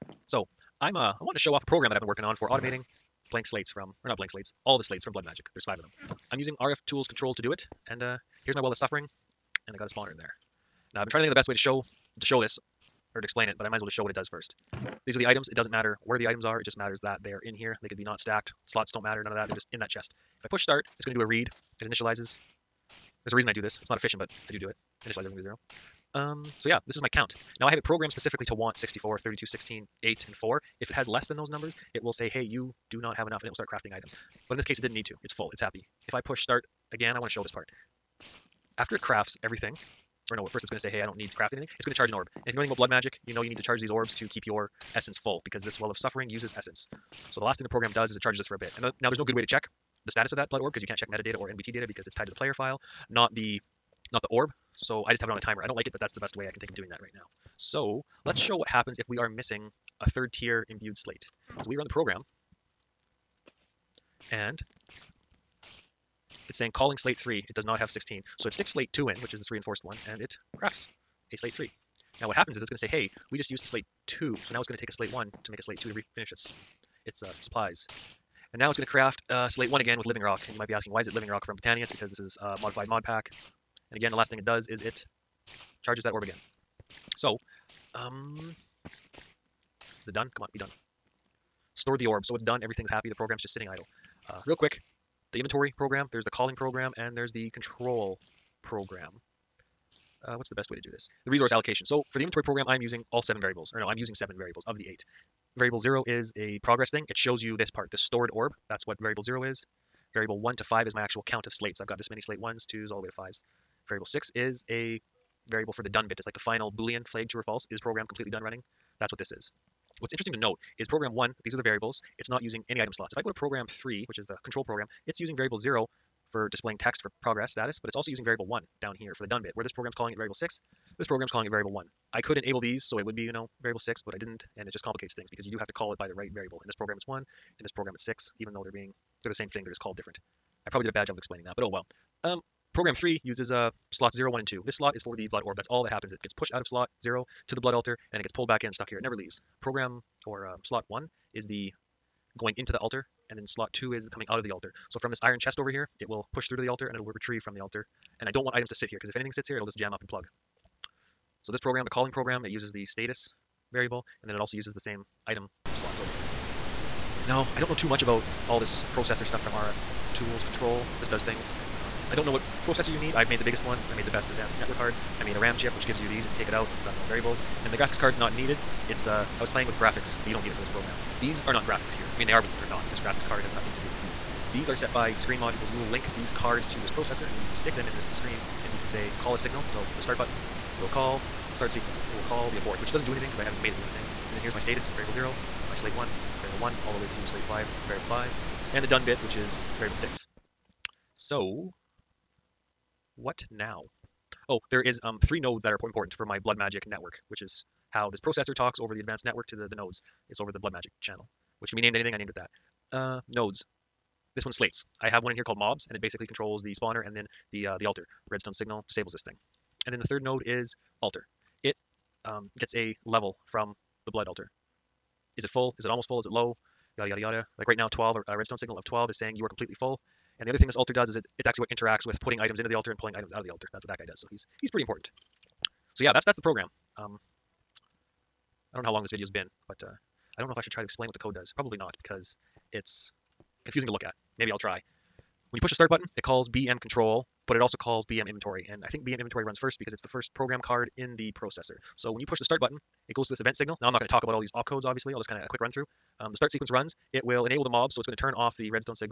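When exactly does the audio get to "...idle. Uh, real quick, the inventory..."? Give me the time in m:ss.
1:33.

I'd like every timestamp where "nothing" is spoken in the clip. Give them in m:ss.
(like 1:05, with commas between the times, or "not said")
3:03.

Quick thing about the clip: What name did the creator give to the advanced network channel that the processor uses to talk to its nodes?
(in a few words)
blood magic channel.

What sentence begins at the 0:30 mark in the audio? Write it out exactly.
If it has less than those numbers, it will say, hey, you do not have enough, and it will start crafting items.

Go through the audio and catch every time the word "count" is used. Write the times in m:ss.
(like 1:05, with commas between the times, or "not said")
0:27, 1:51.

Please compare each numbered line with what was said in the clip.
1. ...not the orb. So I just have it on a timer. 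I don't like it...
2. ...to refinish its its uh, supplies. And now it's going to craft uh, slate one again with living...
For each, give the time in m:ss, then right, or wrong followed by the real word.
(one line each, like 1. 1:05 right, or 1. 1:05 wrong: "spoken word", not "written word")
1. 0:54 right
2. 1:15 right.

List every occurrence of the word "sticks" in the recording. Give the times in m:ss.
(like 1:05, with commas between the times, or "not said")
1:08, 3:07.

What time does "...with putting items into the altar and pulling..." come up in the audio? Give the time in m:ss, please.
3:52.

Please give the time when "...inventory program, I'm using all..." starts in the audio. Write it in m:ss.
1:42.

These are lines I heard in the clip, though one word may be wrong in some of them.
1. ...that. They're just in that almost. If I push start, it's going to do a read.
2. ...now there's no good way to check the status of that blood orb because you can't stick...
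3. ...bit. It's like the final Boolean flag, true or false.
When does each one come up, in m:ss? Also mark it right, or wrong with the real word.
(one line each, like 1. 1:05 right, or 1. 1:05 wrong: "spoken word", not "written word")
1. 0:19 wrong: "chest", not "almost"
2. 0:48 wrong: "check", not "stick"
3. 1:56 right.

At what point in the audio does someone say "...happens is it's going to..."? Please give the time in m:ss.
1:12.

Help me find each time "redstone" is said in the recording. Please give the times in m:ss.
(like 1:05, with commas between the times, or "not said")
3:38, 3:48.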